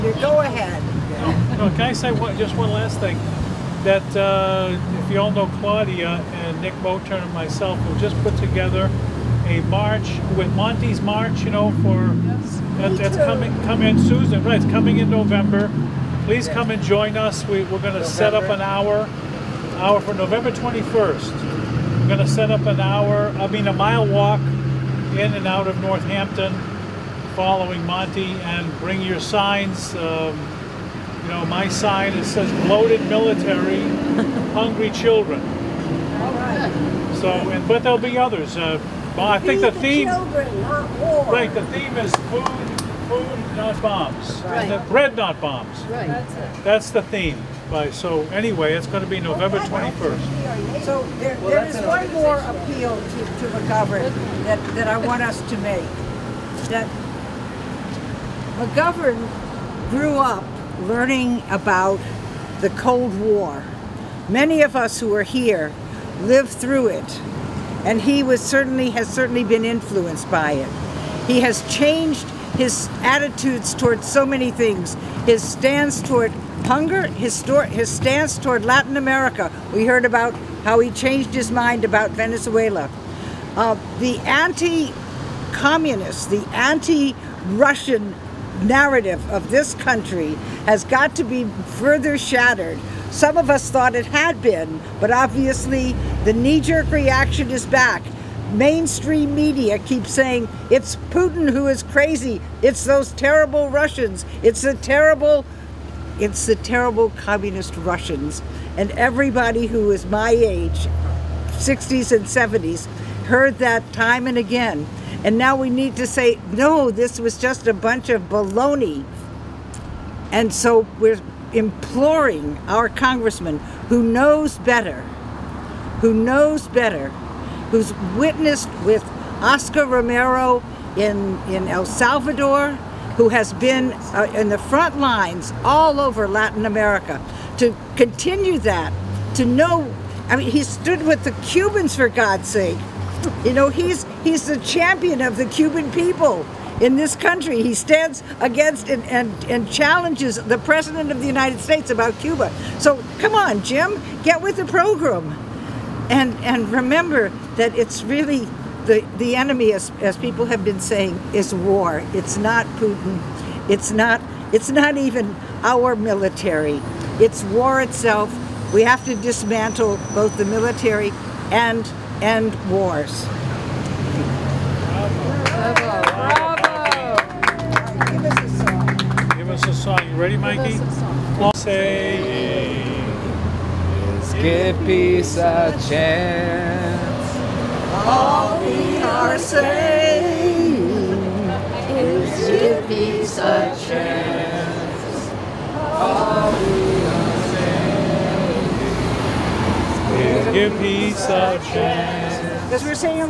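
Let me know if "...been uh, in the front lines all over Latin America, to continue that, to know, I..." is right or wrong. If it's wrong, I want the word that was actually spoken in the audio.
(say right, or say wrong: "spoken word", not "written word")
right.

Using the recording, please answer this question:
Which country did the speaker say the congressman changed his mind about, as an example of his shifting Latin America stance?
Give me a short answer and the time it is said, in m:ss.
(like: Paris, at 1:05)
Venezuela, at 1:22.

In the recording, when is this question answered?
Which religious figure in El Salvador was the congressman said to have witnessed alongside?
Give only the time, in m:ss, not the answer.
2:09.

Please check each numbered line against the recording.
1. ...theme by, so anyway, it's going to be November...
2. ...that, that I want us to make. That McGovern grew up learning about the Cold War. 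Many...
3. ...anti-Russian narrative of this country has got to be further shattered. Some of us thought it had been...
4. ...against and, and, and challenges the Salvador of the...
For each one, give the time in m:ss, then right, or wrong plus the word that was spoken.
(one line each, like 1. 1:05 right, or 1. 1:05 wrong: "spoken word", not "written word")
1. 0:47 right
2. 0:54 right
3. 1:26 right
4. 2:28 wrong: "President", not "Salvador".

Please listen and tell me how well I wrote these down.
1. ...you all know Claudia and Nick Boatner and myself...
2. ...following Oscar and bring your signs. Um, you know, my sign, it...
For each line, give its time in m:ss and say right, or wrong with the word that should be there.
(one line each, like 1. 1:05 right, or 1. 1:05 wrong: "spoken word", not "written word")
1. 0:05 right
2. 0:27 wrong: "Monte", not "Oscar".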